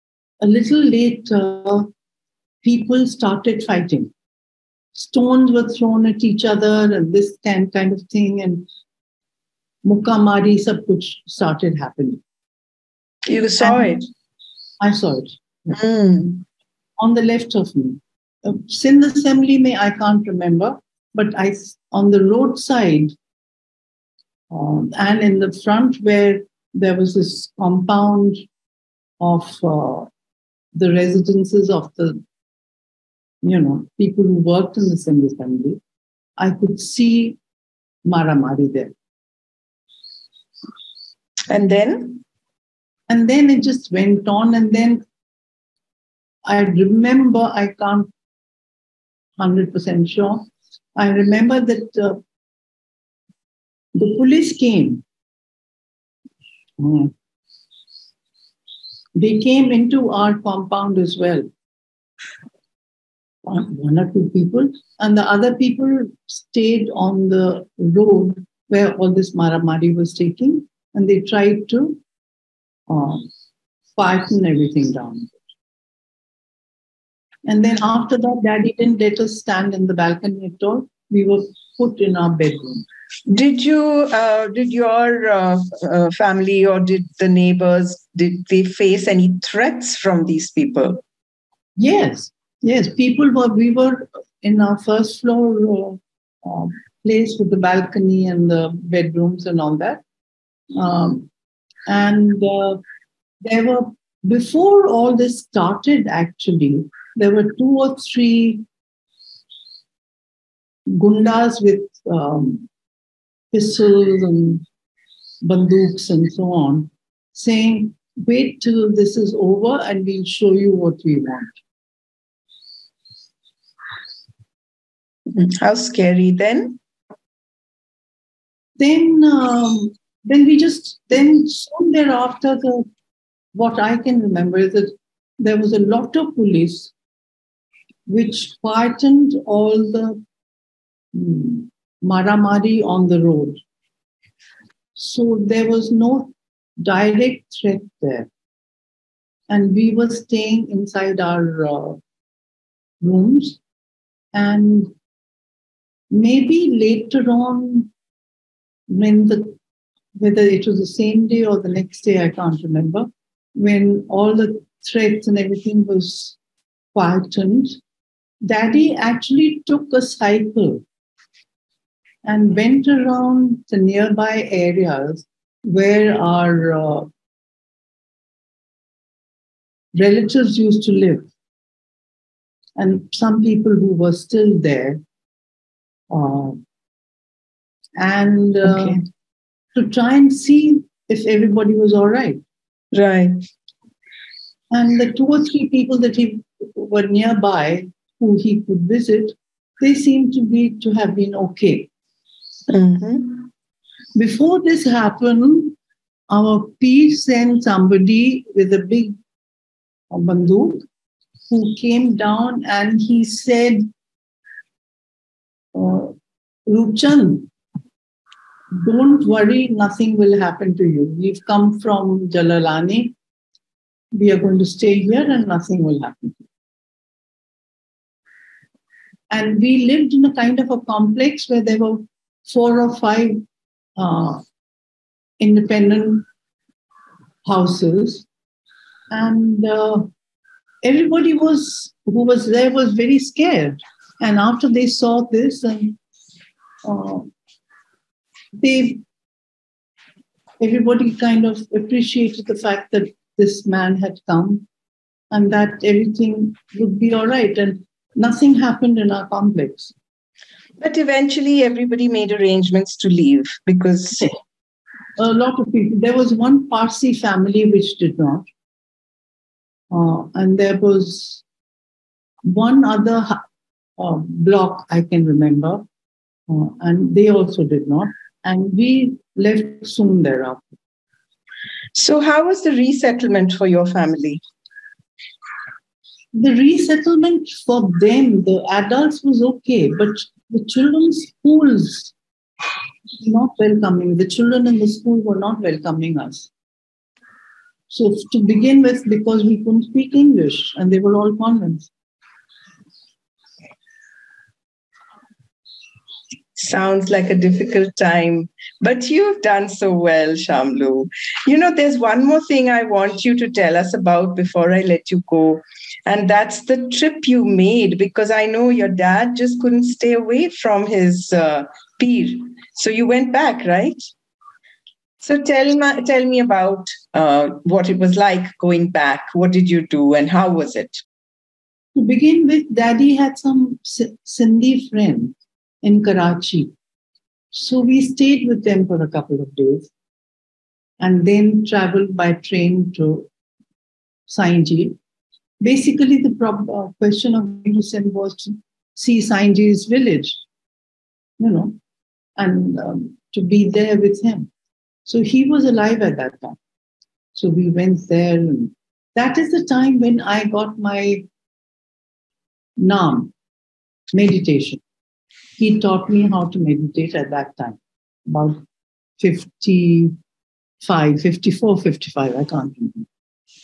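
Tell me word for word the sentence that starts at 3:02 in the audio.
And some people who were still there.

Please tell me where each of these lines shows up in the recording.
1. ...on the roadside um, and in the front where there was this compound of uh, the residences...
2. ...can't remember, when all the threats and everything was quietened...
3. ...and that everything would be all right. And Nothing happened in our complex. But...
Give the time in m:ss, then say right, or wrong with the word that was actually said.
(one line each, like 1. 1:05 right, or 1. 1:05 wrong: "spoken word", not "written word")
1. 0:21 right
2. 2:42 right
3. 4:15 right.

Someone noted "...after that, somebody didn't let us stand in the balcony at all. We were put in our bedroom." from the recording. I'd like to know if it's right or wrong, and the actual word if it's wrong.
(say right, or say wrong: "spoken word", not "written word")
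wrong: "daddy", not "somebody".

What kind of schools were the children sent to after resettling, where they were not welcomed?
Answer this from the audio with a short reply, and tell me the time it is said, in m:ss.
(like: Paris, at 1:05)
Convents, at 5:01.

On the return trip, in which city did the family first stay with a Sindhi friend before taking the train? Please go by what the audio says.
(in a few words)
Karachi.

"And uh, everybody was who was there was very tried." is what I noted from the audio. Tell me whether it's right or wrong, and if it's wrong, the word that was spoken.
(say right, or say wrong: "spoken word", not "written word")
wrong: "scared", not "tried".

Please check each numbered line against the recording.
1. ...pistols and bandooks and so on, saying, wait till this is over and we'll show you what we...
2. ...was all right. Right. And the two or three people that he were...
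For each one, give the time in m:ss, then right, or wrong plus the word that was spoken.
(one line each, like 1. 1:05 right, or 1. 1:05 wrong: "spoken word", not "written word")
1. 1:53 right
2. 3:11 right.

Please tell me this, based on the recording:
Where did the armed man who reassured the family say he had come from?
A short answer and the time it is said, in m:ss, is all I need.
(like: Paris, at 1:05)
Jalalani, at 3:42.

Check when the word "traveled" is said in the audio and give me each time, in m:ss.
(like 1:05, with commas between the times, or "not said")
5:41.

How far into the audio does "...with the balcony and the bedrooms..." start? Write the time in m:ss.
1:37.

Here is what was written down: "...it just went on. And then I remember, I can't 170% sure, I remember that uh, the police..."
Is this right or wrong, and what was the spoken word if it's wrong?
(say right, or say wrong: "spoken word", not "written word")
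wrong: "100", not "170".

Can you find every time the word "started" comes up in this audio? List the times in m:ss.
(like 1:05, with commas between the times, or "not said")
0:03, 0:11, 1:45.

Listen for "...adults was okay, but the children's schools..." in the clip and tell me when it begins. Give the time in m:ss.
4:48.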